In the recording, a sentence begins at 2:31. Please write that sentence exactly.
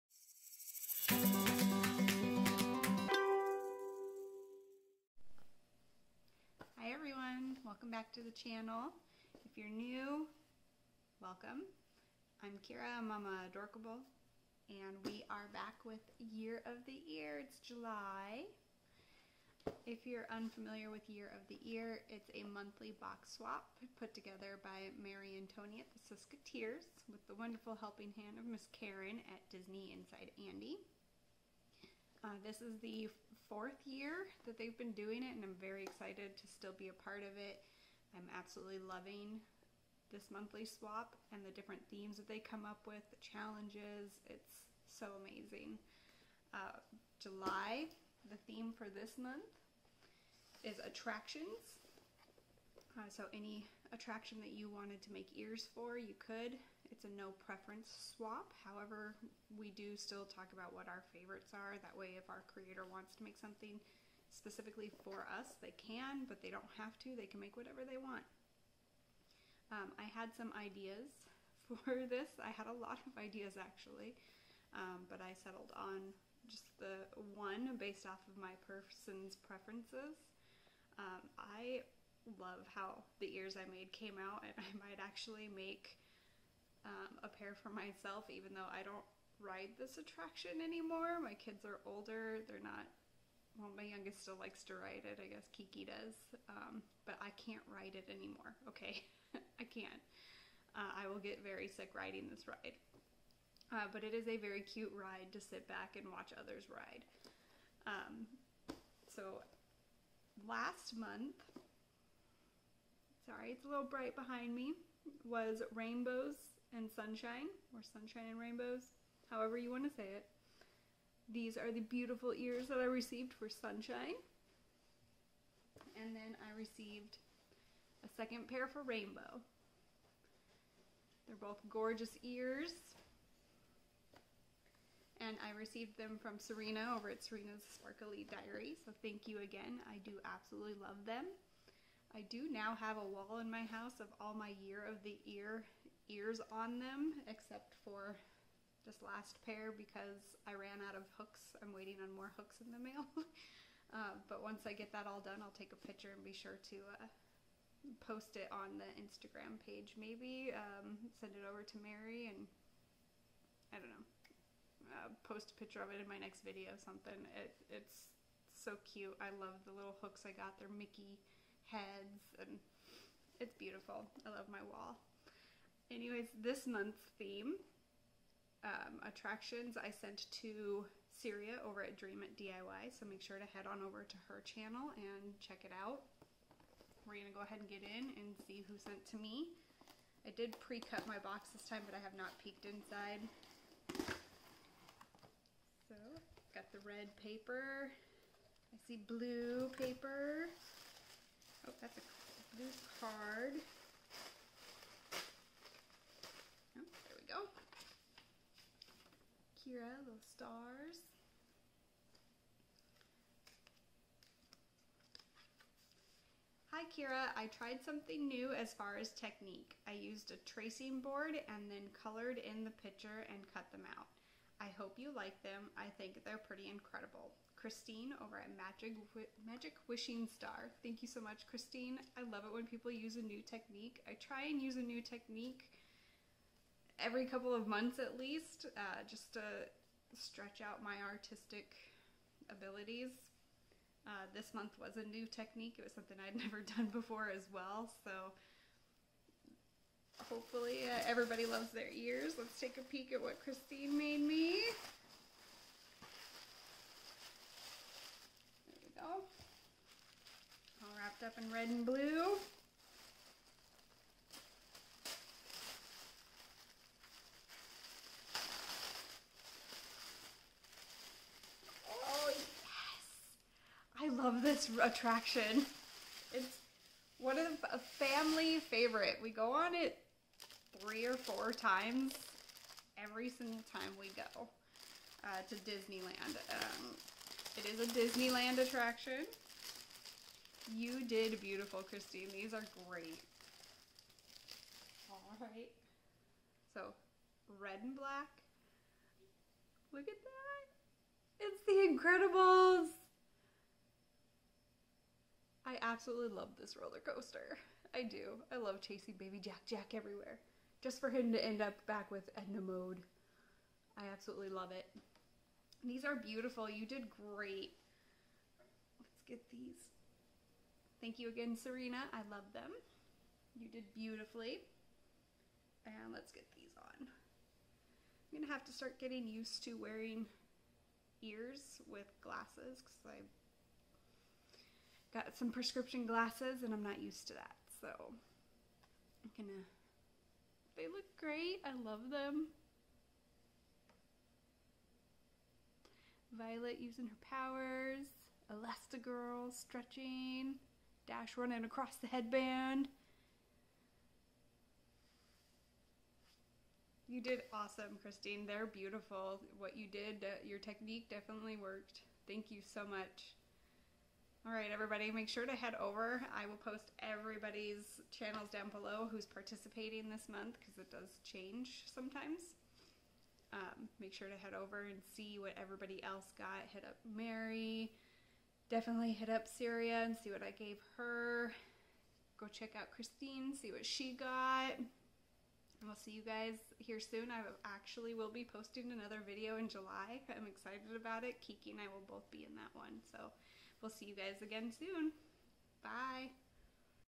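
I'm waiting on more hooks in the mail.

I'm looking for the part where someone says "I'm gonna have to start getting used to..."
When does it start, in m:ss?
5:28.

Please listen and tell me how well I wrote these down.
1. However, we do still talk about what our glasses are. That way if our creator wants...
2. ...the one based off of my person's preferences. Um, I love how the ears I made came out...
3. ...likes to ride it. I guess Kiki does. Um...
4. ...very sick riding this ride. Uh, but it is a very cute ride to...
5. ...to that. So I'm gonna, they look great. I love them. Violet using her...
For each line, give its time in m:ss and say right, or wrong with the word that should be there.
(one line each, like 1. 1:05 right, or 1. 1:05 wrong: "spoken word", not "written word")
1. 0:58 wrong: "favorites", not "glasses"
2. 1:16 right
3. 1:34 right
4. 1:41 right
5. 5:37 right.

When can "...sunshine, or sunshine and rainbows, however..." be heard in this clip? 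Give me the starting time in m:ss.
1:56.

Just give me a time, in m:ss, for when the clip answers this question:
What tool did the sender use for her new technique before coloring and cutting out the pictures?
3:40.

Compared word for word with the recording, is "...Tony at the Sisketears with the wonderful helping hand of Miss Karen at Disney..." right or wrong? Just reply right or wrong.
right.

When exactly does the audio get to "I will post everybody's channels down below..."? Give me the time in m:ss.
6:06.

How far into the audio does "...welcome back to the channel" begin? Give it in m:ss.
0:07.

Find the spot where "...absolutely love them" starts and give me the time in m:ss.
2:20.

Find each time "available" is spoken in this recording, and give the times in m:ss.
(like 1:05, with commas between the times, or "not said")
not said.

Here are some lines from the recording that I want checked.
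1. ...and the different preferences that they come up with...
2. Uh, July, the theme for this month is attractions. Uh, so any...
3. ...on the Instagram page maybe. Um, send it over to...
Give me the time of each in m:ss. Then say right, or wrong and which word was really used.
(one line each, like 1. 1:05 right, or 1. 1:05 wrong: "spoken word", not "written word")
1. 0:41 wrong: "themes", not "preferences"
2. 0:46 right
3. 2:38 right.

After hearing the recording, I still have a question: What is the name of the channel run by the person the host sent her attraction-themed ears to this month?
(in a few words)
Dream It DIY.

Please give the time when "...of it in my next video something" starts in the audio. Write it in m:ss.
2:45.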